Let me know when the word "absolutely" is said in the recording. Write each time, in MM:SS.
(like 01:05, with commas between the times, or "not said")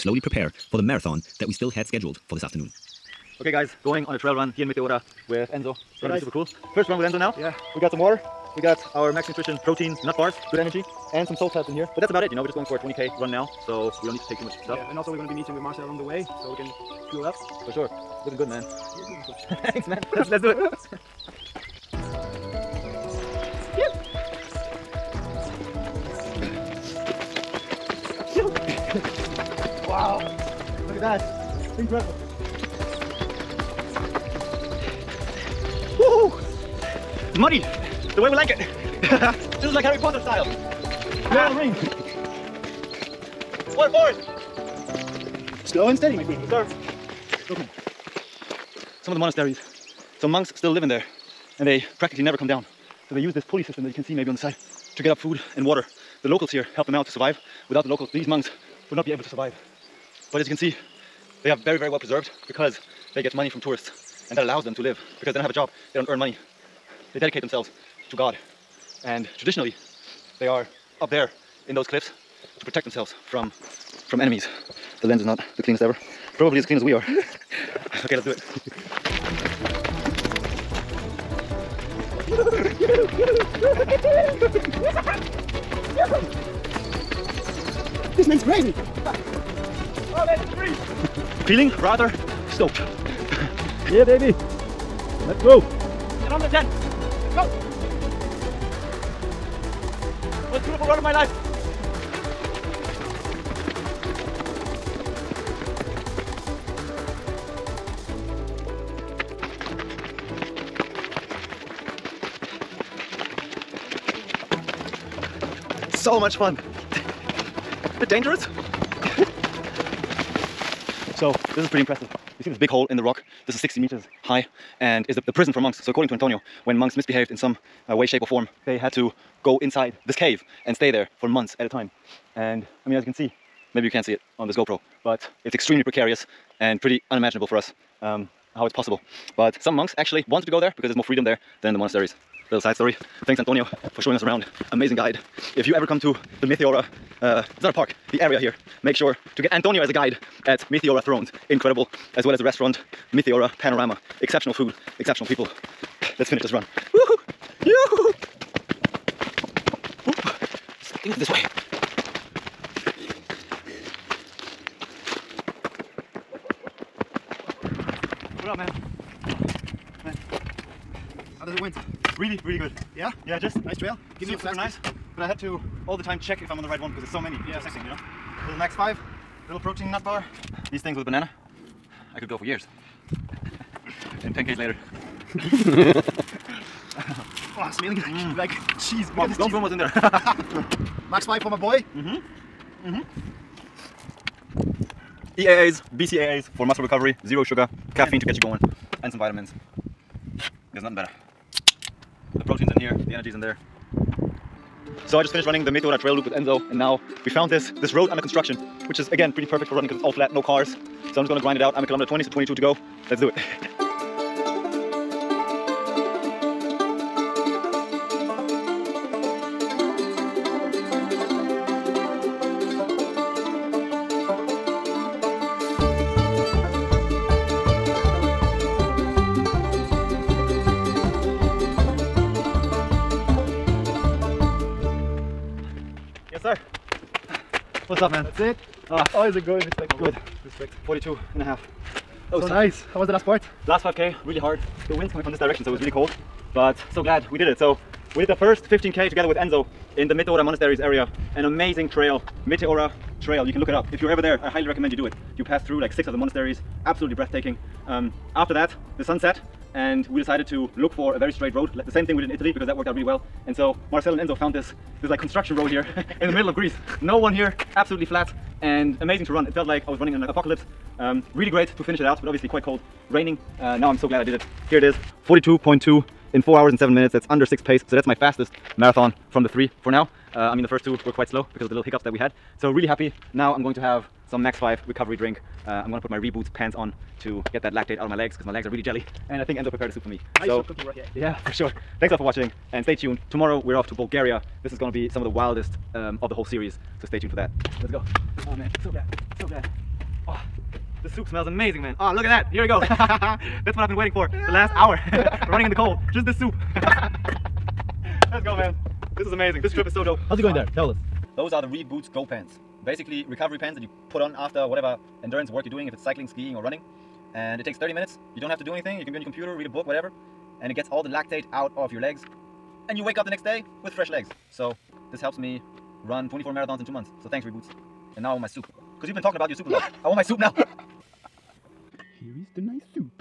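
04:16, 04:27.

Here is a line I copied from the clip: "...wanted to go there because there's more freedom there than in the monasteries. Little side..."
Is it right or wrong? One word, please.
right.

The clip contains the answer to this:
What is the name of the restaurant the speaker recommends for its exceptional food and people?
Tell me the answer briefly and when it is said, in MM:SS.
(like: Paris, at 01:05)
Meteora Panorama, at 02:33.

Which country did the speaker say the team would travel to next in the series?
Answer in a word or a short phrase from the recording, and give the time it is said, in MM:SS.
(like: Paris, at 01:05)
Bulgaria, at 04:53.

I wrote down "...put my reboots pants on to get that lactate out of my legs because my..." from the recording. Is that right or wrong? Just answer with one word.
right.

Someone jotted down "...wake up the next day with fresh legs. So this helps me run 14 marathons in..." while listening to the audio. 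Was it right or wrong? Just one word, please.
wrong.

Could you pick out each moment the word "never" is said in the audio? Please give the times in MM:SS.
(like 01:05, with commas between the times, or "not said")
00:52.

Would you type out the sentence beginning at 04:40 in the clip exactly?
Uh, I mean, the first two were quite slow because of the little hiccups that we had.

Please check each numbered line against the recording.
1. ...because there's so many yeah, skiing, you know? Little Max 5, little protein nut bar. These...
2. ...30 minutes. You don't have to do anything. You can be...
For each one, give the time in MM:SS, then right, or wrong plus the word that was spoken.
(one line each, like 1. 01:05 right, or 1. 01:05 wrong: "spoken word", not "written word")
1. 02:56 wrong: "intersecting", not "skiing"
2. 05:17 right.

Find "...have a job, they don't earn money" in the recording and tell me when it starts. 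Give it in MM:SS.
01:05.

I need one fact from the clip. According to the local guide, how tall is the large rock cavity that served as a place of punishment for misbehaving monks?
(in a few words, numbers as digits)
60 meters.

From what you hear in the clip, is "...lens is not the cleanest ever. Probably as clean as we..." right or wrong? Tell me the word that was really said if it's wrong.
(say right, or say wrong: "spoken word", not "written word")
right.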